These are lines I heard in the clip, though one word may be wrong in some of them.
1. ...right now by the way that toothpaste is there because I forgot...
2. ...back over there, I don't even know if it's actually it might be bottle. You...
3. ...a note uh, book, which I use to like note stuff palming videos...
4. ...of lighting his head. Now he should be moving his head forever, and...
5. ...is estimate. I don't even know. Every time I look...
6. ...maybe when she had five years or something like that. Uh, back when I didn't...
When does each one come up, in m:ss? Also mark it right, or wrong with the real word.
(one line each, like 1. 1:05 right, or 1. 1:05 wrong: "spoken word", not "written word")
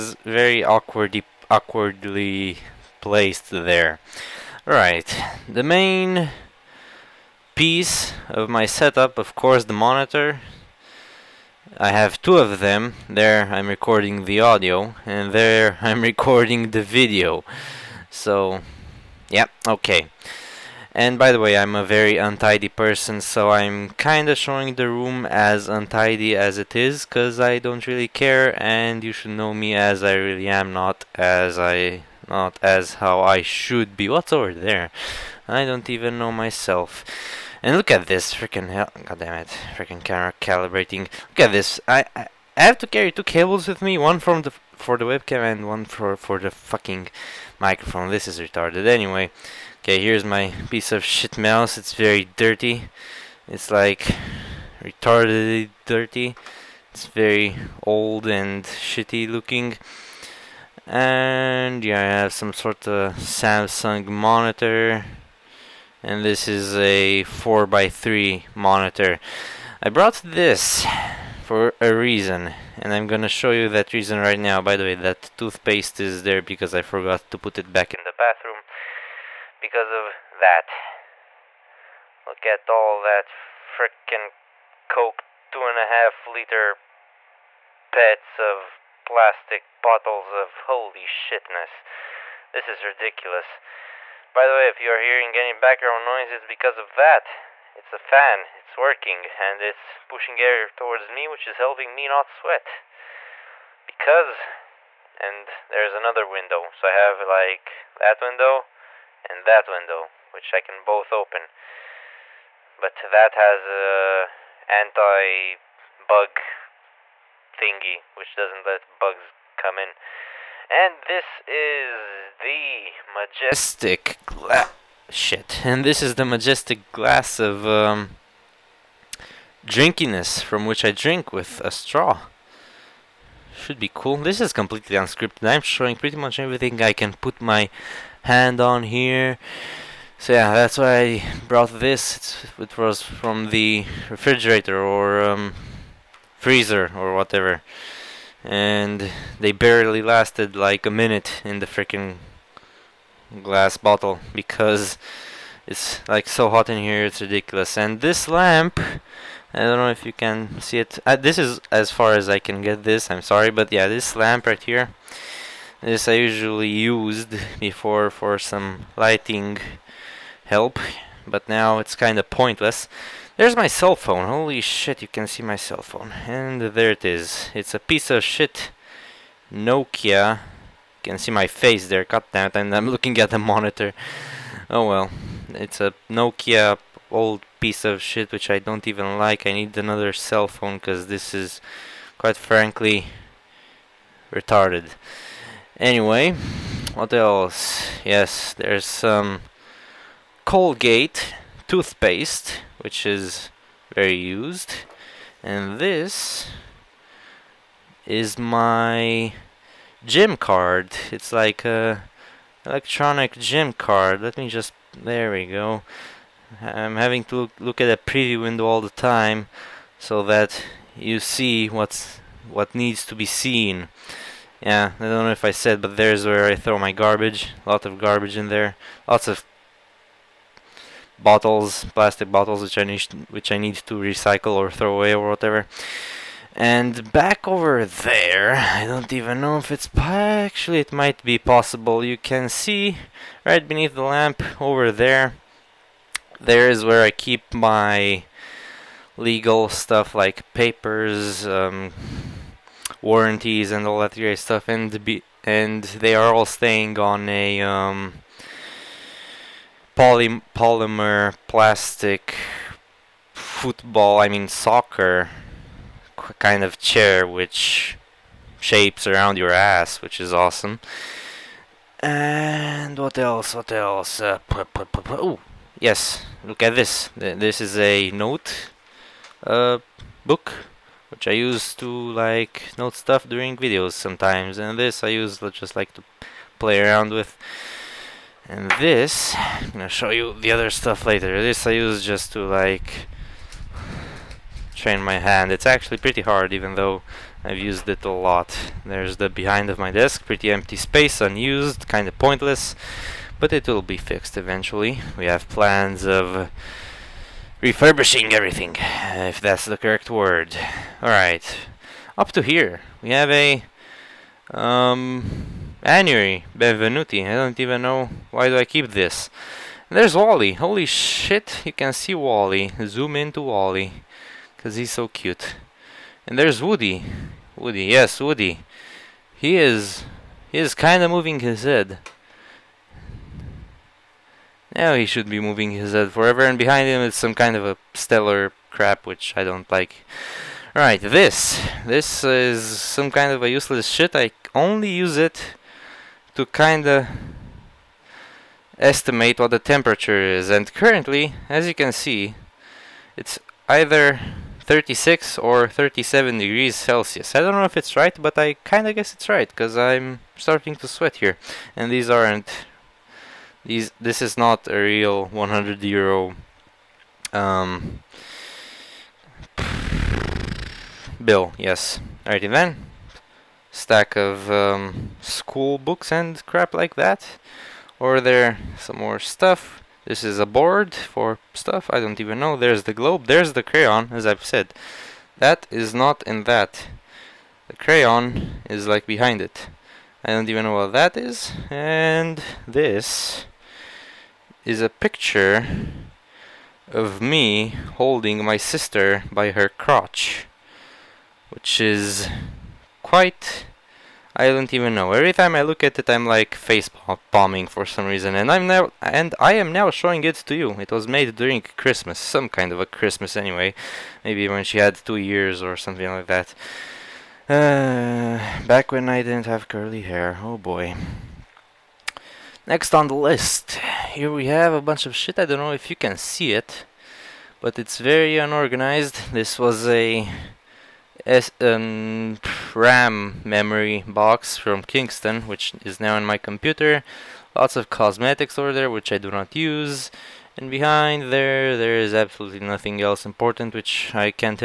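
1. 1:14 right
2. 3:57 wrong: "possible", not "bottle"
3. 4:37 wrong: "during", not "palming"
4. 5:31 wrong: "moving", not "lighting"
5. 6:41 wrong: "quite", not "estimate"
6. 6:54 wrong: "two", not "five".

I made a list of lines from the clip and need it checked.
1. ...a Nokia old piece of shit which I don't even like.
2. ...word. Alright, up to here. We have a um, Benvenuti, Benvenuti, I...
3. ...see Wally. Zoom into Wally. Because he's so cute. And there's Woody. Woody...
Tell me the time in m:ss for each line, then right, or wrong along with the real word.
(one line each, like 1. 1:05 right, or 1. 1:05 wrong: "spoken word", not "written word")
1. 3:05 right
2. 5:10 wrong: "Anyway", not "Benvenuti"
3. 5:21 right.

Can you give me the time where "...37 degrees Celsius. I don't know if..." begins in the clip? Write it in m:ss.
5:55.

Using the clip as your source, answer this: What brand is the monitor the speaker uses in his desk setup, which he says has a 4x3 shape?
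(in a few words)
Samsung.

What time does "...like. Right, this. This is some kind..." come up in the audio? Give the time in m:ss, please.
5:39.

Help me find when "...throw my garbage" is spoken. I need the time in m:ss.
3:46.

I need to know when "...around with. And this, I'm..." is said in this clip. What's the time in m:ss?
4:46.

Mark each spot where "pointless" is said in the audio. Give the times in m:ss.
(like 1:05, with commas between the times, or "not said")
2:52, 5:02.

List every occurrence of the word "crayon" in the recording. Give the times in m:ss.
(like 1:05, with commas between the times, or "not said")
6:23, 6:27.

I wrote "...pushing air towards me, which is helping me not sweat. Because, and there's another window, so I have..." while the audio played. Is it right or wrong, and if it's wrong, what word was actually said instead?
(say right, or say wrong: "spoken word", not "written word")
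right.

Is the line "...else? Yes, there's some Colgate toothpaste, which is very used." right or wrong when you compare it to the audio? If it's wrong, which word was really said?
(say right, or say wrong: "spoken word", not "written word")
right.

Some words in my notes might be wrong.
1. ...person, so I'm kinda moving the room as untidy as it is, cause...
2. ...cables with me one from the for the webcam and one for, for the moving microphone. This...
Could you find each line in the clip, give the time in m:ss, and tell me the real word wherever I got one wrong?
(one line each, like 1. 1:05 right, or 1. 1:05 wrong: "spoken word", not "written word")
1. 0:22 wrong: "showing", not "moving"
2. 0:43 wrong: "fucking", not "moving".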